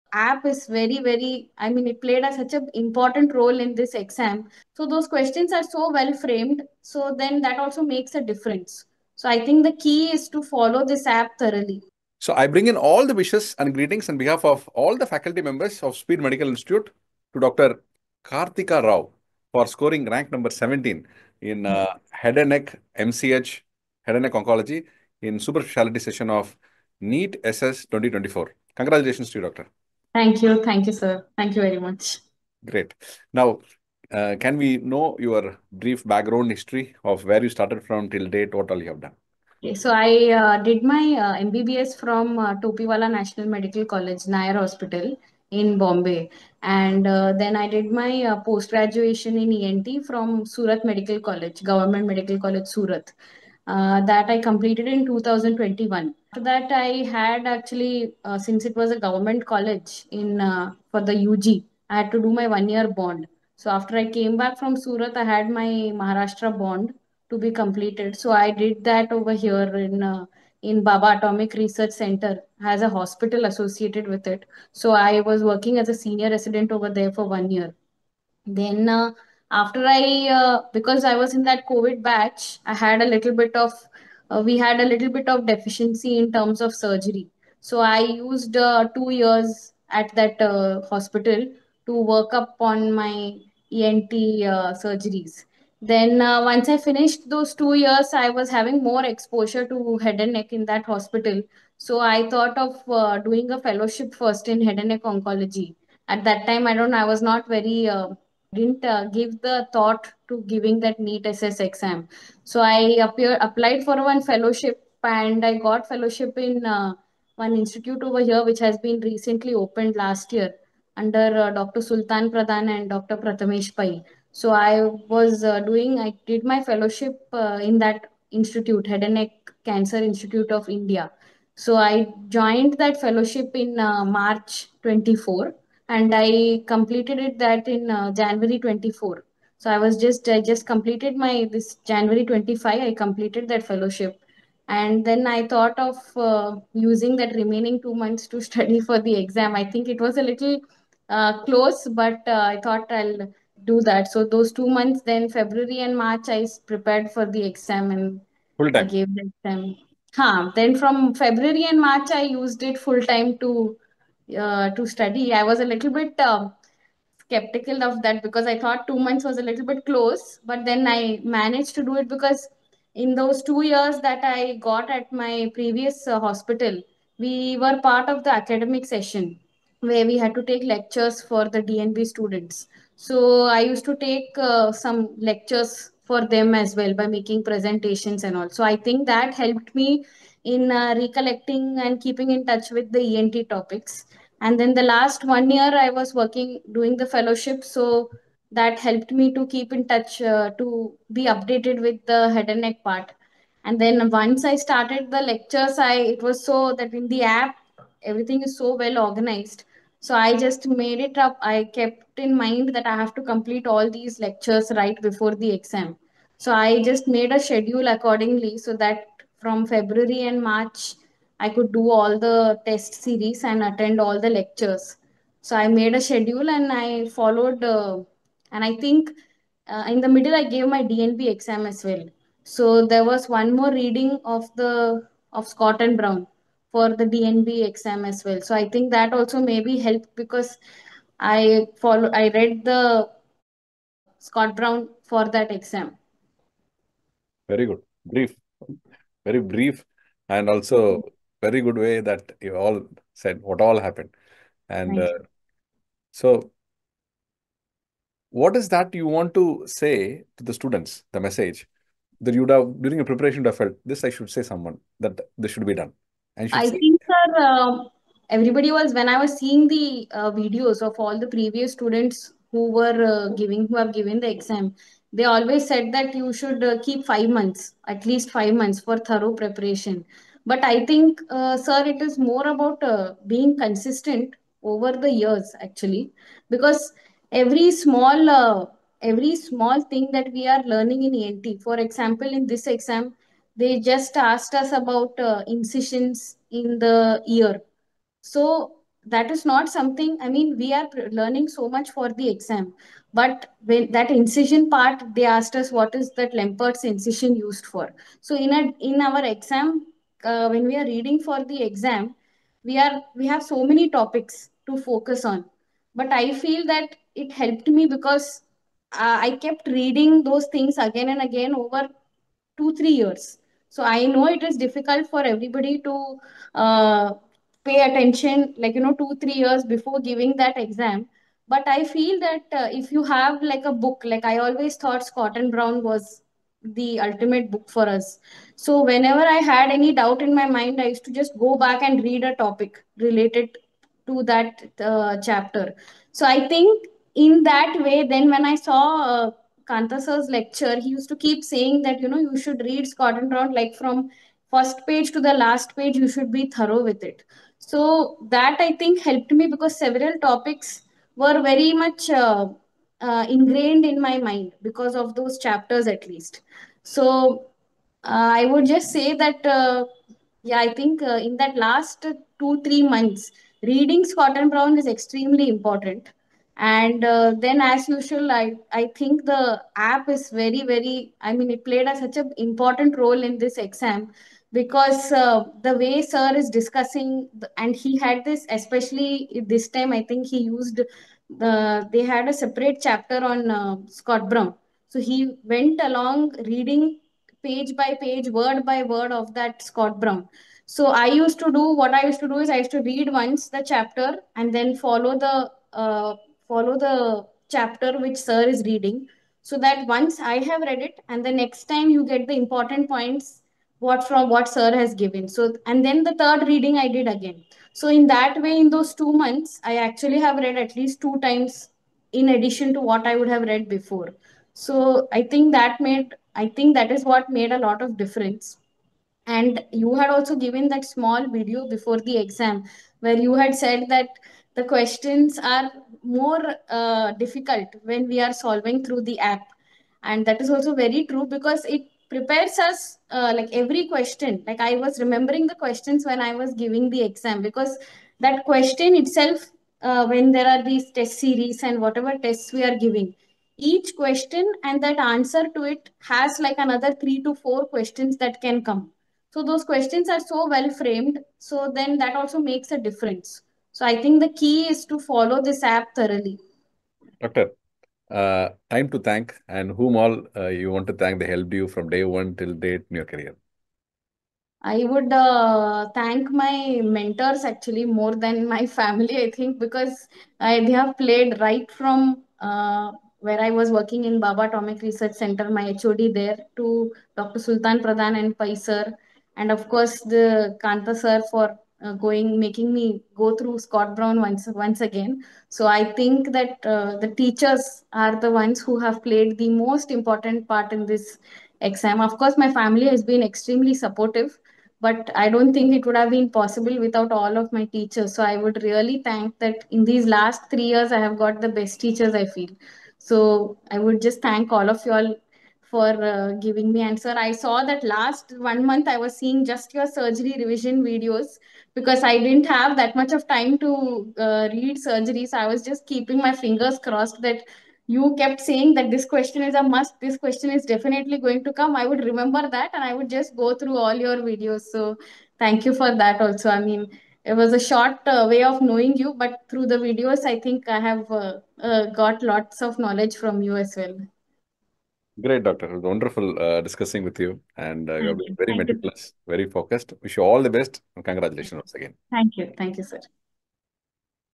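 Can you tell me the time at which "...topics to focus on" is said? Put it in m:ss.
5:13.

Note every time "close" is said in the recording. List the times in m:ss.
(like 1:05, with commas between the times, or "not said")
2:31, 2:49.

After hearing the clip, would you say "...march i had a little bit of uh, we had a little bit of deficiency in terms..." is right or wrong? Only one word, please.
wrong.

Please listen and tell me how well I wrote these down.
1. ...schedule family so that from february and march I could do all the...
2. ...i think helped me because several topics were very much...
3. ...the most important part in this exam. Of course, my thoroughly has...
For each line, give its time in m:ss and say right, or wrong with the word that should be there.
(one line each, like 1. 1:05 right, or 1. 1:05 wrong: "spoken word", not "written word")
1. 3:37 wrong: "accordingly", not "family"
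2. 5:58 right
3. 8:19 wrong: "family", not "thoroughly".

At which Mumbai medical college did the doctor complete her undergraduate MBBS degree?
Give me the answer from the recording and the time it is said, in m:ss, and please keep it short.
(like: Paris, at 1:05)
Topiwala National Medical College, at 0:42.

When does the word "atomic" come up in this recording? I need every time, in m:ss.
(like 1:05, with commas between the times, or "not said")
1:11, 8:04.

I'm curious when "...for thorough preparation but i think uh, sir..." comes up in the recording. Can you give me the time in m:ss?
4:38.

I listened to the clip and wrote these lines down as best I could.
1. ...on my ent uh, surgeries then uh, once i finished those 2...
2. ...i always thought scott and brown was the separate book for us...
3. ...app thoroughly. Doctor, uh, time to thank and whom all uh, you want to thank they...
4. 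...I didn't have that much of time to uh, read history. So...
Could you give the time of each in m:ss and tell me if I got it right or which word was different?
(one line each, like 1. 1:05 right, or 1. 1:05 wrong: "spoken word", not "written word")
1. 1:32 right
2. 5:34 wrong: "ultimate", not "separate"
3. 7:45 right
4. 8:42 wrong: "surgery", not "history".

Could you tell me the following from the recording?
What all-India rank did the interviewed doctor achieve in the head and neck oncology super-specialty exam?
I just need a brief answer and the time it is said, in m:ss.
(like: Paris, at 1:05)
17, at 0:20.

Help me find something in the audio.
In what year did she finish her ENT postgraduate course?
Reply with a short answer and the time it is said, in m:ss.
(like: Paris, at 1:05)
2021, at 0:55.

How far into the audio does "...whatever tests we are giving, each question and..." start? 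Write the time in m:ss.
7:31.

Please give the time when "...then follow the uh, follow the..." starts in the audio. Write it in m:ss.
6:44.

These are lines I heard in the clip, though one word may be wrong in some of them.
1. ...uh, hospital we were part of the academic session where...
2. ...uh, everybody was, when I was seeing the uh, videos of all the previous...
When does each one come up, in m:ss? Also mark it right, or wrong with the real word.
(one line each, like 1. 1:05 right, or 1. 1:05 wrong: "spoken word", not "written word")
1. 2:56 right
2. 4:27 right.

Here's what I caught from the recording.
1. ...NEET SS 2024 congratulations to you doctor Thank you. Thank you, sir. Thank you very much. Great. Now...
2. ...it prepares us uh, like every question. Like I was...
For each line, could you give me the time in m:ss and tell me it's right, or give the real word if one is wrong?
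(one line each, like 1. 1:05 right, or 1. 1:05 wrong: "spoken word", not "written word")
1. 0:26 right
2. 7:21 right.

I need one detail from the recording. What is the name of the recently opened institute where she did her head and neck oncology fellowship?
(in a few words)
Head and Neck Cancer Institute of India.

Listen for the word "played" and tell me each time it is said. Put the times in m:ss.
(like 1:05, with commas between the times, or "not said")
0:02, 6:21, 8:00, 8:19.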